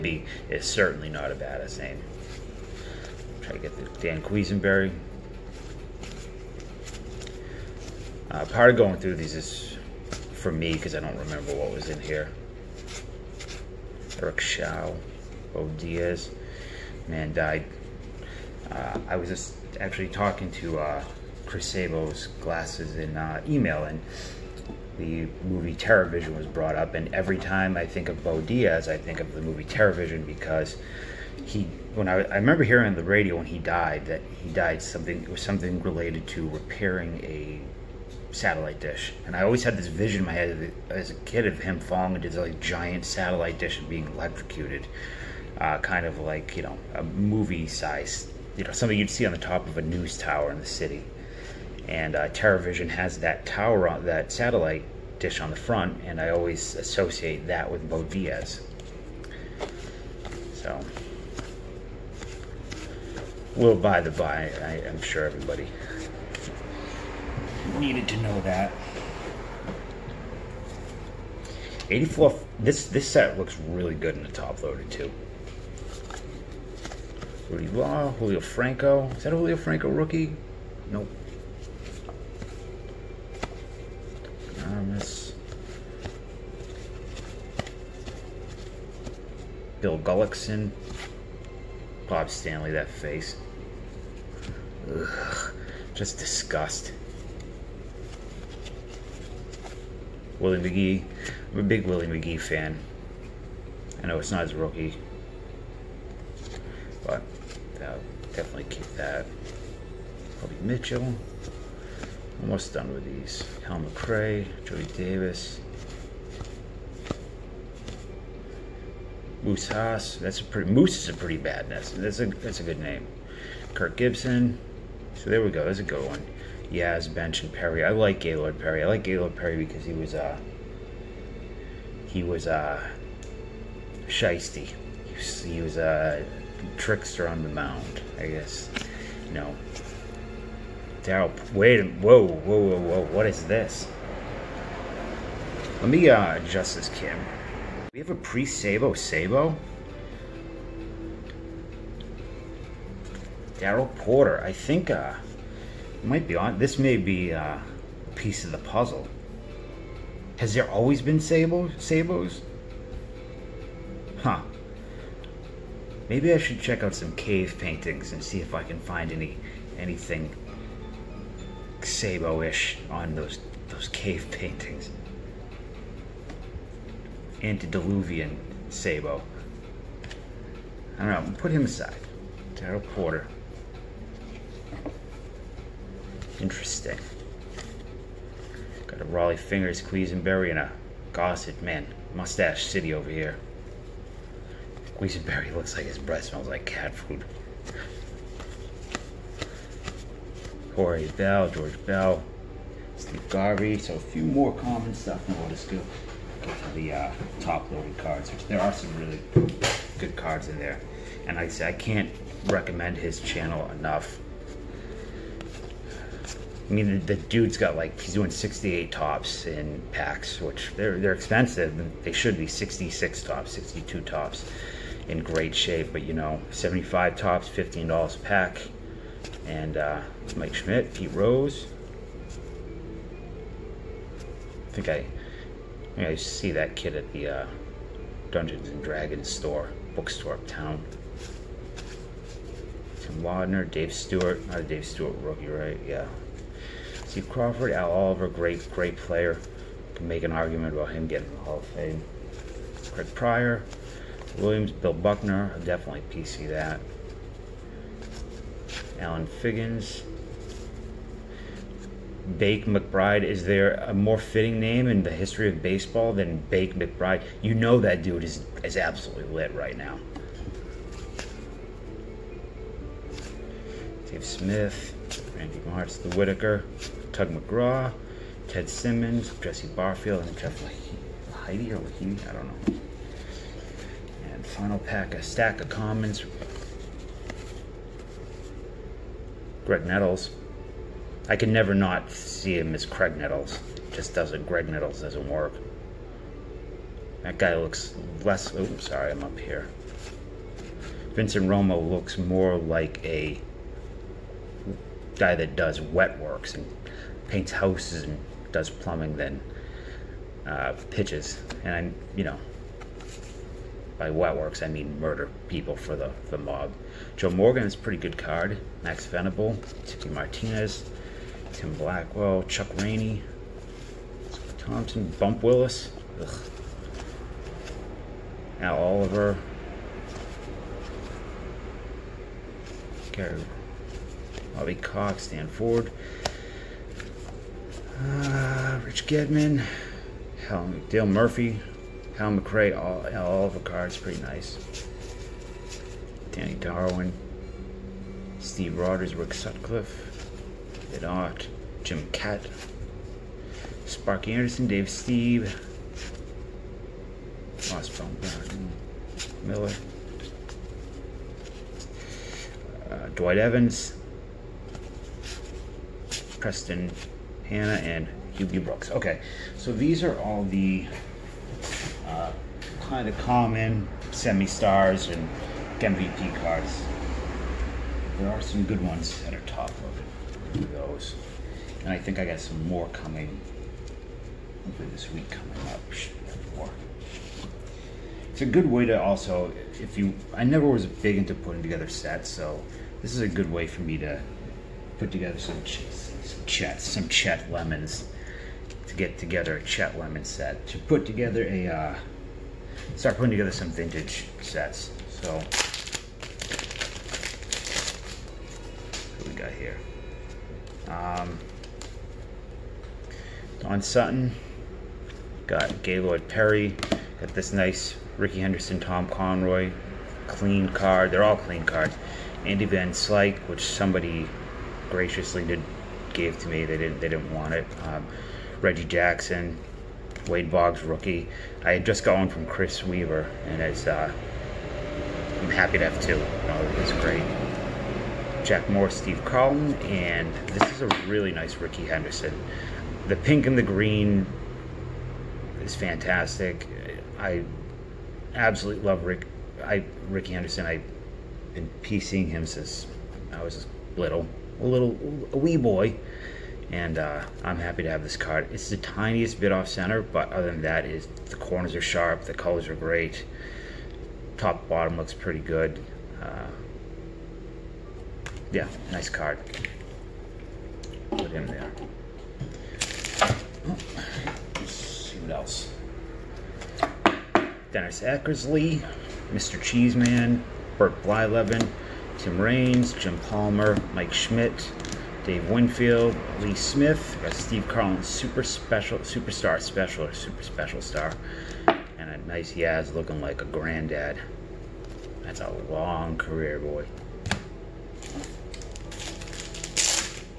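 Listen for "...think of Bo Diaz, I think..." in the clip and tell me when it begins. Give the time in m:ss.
0:27.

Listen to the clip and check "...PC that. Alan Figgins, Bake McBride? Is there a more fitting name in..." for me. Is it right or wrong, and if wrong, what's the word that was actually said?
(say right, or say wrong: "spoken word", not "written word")
right.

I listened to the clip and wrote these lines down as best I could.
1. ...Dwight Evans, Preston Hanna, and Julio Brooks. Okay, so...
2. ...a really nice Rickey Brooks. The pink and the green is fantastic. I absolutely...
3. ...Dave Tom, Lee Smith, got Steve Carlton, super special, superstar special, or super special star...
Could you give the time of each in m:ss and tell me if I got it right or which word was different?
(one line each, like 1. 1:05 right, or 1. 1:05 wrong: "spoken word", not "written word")
1. 6:03 wrong: "Hubie", not "Julio"
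2. 7:20 wrong: "Henderson", not "Brooks"
3. 8:05 wrong: "Winfield", not "Tom".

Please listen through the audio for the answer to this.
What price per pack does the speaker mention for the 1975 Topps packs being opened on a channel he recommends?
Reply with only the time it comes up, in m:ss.
3:47.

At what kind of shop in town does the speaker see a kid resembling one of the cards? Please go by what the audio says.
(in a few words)
Dungeons and Dragons store.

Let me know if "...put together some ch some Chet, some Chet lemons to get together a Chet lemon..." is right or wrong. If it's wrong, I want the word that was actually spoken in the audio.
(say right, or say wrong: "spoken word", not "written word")
right.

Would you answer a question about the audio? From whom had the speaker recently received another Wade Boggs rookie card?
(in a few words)
Chris Weaver.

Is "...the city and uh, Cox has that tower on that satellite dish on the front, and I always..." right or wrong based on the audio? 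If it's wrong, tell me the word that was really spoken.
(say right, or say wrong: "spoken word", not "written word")
wrong: "TerrorVision", not "Cox".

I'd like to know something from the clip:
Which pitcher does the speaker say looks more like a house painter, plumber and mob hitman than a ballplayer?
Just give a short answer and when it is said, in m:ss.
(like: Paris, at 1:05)
Vincent Romo, at 5:01.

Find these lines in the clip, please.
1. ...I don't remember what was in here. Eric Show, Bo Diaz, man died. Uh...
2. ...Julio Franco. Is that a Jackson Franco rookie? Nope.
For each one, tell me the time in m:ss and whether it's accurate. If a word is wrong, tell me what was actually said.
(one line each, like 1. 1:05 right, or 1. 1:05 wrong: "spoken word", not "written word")
1. 0:10 right
2. 1:18 wrong: "Julio", not "Jackson".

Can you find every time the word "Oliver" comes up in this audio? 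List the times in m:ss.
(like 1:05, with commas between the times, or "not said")
4:07, 5:28, 5:43.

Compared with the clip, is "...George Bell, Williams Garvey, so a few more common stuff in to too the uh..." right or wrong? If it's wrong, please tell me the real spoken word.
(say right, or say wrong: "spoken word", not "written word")
wrong: "Steve", not "Williams".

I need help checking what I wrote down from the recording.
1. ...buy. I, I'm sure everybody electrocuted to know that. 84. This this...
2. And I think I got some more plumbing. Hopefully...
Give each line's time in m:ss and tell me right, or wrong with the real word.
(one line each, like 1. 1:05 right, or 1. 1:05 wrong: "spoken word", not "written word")
1. 1:04 wrong: "needed", not "electrocuted"
2. 6:21 wrong: "coming", not "plumbing".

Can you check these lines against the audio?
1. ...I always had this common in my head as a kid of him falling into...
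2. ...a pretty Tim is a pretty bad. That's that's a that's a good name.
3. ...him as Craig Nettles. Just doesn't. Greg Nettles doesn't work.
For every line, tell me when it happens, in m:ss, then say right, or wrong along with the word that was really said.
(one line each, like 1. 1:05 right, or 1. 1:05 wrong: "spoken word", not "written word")
1. 0:39 wrong: "vision", not "common"
2. 2:00 wrong: "Moose", not "Tim"
3. 4:52 right.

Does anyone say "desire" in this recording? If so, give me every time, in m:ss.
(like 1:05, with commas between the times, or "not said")
not said.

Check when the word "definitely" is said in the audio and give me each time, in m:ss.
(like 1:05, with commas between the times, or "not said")
1:48, 4:15.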